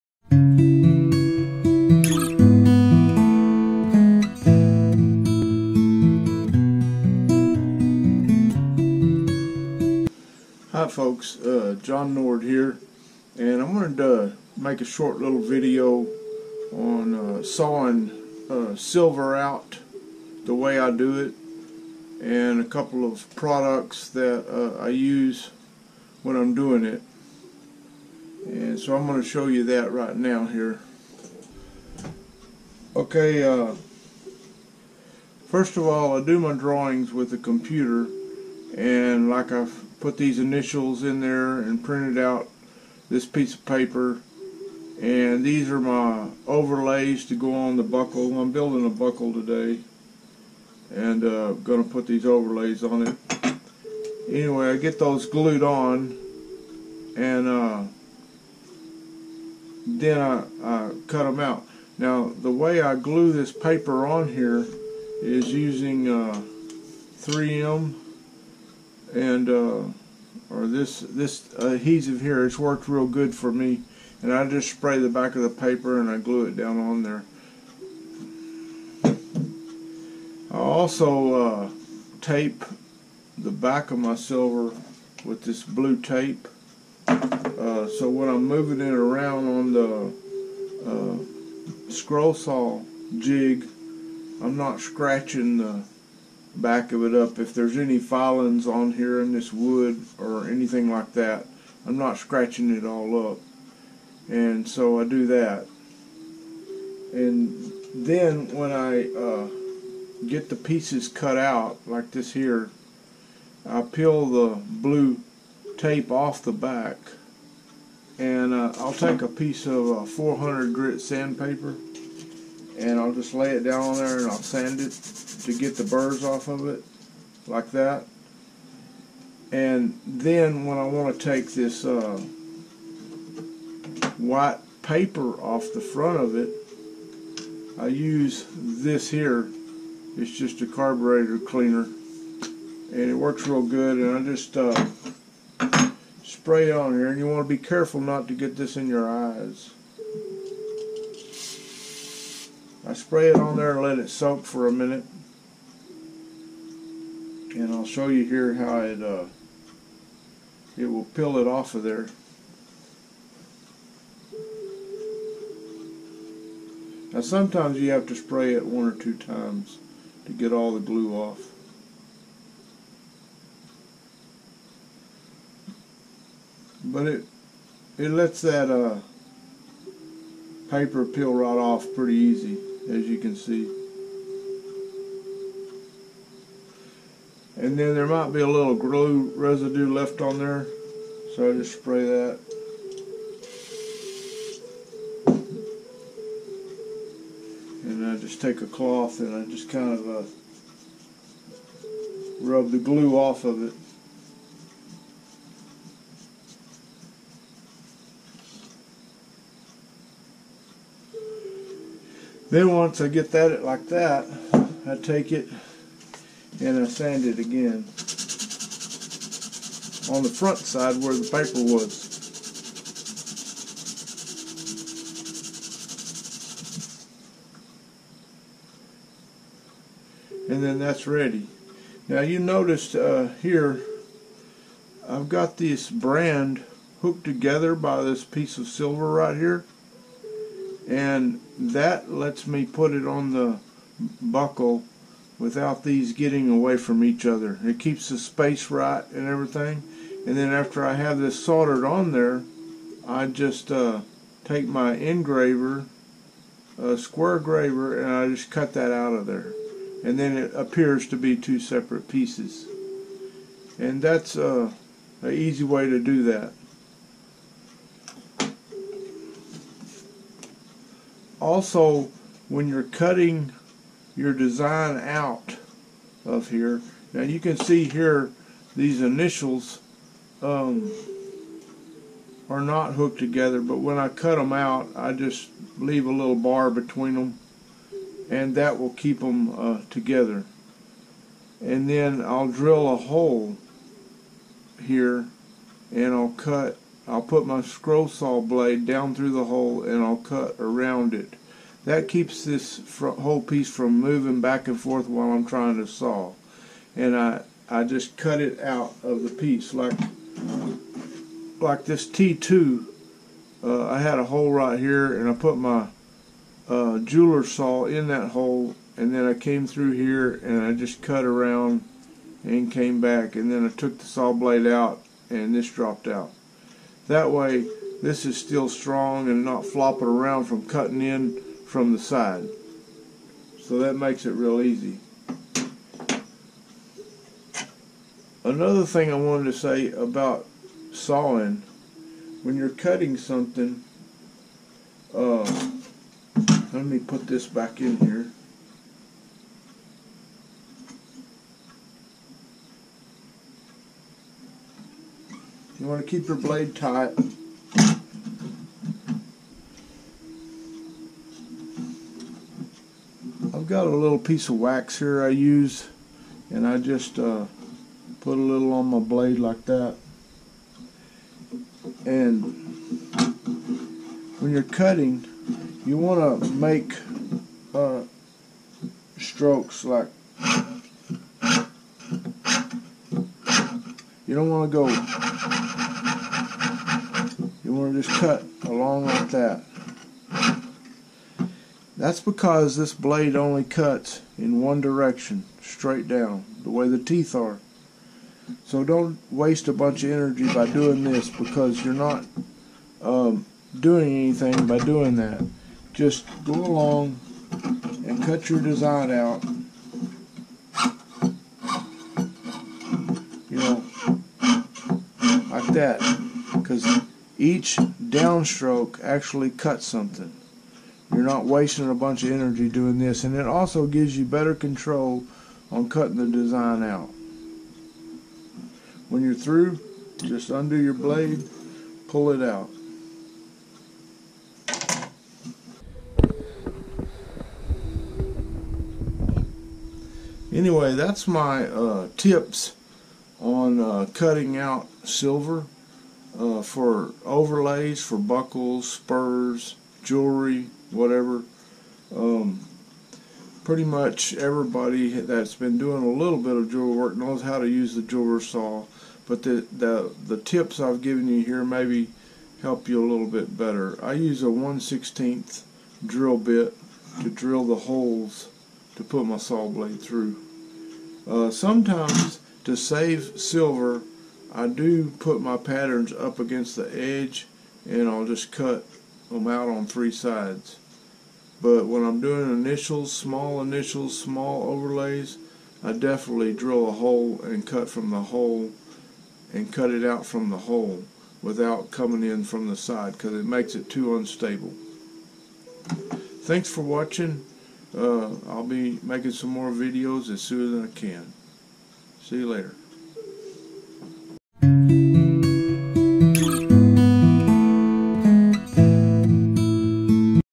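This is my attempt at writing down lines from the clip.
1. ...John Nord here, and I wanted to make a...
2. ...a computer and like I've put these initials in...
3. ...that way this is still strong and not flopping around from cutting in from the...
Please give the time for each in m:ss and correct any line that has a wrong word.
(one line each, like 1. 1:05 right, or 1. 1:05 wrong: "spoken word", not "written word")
1. 0:11 right
2. 0:37 right
3. 5:27 right.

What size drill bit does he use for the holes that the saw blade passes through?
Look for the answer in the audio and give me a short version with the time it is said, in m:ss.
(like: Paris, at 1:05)
1/16, at 7:44.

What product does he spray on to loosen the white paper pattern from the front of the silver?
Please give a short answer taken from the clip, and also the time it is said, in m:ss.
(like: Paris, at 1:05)
carburetor cleaner, at 2:20.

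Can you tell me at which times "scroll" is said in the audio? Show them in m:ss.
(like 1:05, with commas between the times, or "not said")
1:31, 4:57.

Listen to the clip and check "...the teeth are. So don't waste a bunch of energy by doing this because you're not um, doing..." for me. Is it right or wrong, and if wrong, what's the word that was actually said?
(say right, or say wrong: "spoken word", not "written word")
right.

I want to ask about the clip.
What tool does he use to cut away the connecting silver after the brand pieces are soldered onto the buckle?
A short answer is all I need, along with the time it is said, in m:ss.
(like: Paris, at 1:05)
square graver, at 4:16.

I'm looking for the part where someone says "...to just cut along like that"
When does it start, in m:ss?
6:27.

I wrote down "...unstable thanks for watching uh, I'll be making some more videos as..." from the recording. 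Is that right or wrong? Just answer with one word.
right.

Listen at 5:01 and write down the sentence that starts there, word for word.
That keeps this whole piece from moving back and forth while I'm trying to saw.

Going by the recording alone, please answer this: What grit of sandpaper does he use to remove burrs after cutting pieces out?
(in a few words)
400.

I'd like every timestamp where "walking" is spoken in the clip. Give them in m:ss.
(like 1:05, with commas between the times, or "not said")
not said.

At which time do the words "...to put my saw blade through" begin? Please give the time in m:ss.
7:48.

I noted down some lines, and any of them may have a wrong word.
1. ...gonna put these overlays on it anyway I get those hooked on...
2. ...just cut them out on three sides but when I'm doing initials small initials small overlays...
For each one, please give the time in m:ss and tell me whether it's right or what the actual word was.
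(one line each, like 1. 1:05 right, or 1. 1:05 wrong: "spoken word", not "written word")
1. 0:51 wrong: "glued", not "hooked"
2. 7:58 right.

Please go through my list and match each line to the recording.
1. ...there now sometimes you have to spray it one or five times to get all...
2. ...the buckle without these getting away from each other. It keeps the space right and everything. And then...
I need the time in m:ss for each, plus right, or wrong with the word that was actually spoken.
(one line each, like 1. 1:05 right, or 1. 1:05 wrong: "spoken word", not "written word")
1. 2:41 wrong: "two", not "five"
2. 4:03 right.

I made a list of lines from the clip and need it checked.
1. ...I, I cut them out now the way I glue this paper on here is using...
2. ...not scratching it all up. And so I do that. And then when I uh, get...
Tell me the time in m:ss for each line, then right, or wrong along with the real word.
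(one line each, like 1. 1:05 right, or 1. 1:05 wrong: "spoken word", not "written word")
1. 1:00 right
2. 1:41 right.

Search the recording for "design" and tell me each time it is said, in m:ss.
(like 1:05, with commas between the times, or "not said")
4:34, 6:48, 7:06.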